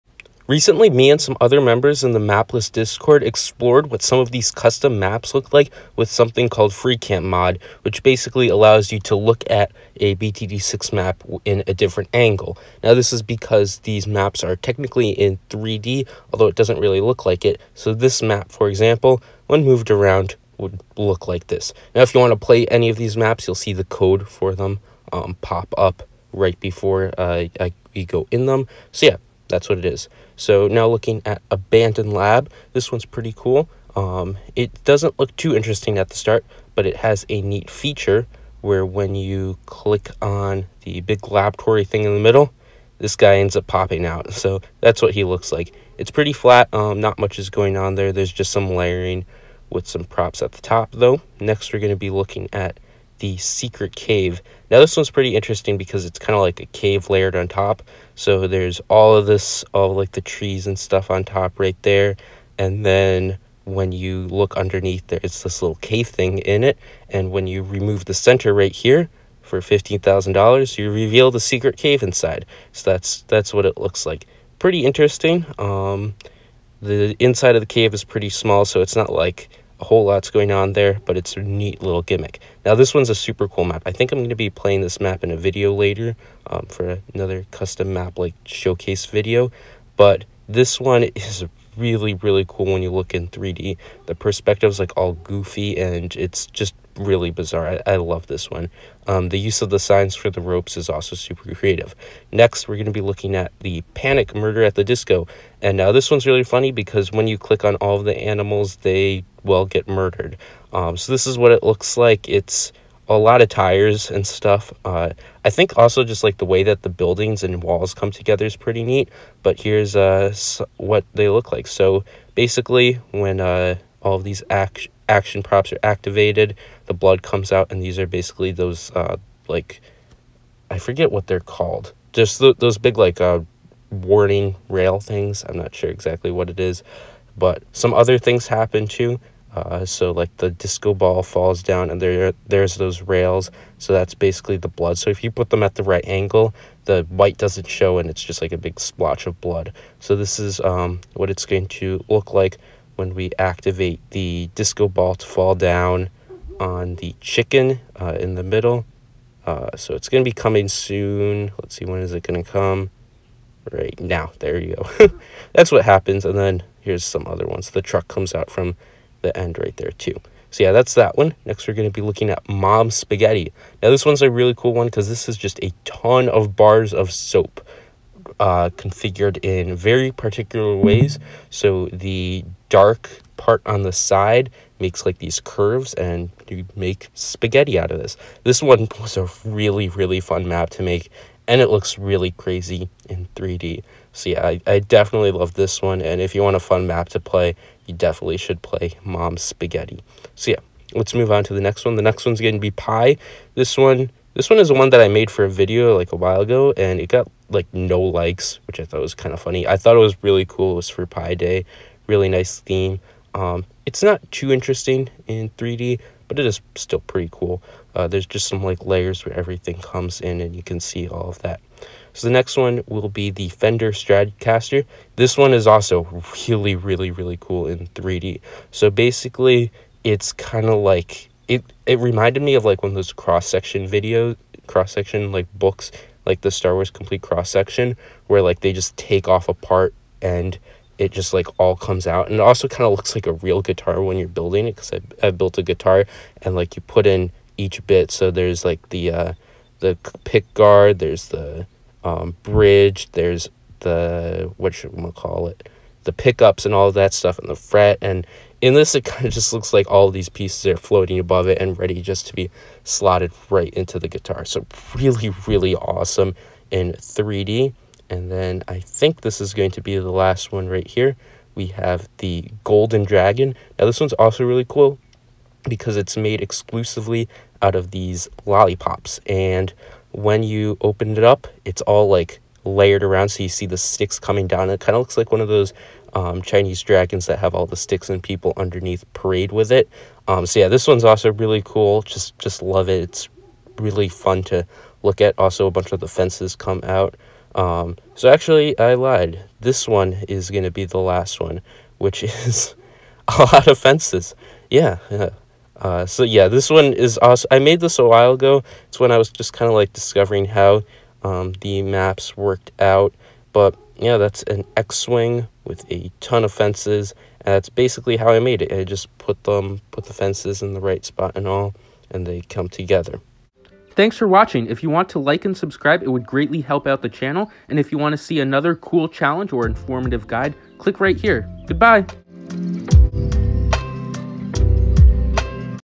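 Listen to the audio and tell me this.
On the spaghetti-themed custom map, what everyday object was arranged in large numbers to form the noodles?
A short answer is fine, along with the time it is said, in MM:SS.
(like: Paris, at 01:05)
bars of soap, at 02:56.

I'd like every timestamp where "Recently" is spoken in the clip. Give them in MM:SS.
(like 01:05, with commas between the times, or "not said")
00:00.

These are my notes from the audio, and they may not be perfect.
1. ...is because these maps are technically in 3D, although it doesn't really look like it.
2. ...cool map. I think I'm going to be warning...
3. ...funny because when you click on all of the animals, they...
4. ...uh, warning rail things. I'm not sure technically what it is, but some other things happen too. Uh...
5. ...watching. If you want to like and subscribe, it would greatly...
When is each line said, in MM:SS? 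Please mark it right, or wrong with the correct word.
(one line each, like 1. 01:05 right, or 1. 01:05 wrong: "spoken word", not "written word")
1. 00:13 right
2. 01:23 wrong: "playing", not "warning"
3. 01:46 right
4. 02:13 wrong: "exactly", not "technically"
5. 05:24 right.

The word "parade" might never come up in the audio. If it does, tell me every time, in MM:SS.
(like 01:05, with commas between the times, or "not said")
04:49.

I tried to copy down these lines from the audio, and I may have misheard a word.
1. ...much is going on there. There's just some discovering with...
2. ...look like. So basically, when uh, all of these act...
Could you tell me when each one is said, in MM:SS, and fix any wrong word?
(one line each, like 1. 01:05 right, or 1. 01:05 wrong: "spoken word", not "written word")
1. 00:47 wrong: "layering", not "discovering"
2. 02:01 right.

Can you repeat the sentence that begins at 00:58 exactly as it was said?
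So there's all of this, all like the trees and stuff on top right there.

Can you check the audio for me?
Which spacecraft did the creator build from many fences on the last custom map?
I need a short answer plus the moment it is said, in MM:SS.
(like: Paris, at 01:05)
X-wing, at 05:14.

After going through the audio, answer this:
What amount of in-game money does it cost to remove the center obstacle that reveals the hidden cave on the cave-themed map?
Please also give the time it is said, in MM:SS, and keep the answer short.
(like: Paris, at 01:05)
$15,000, at 01:09.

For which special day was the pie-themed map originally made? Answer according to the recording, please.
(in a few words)
Pie Day.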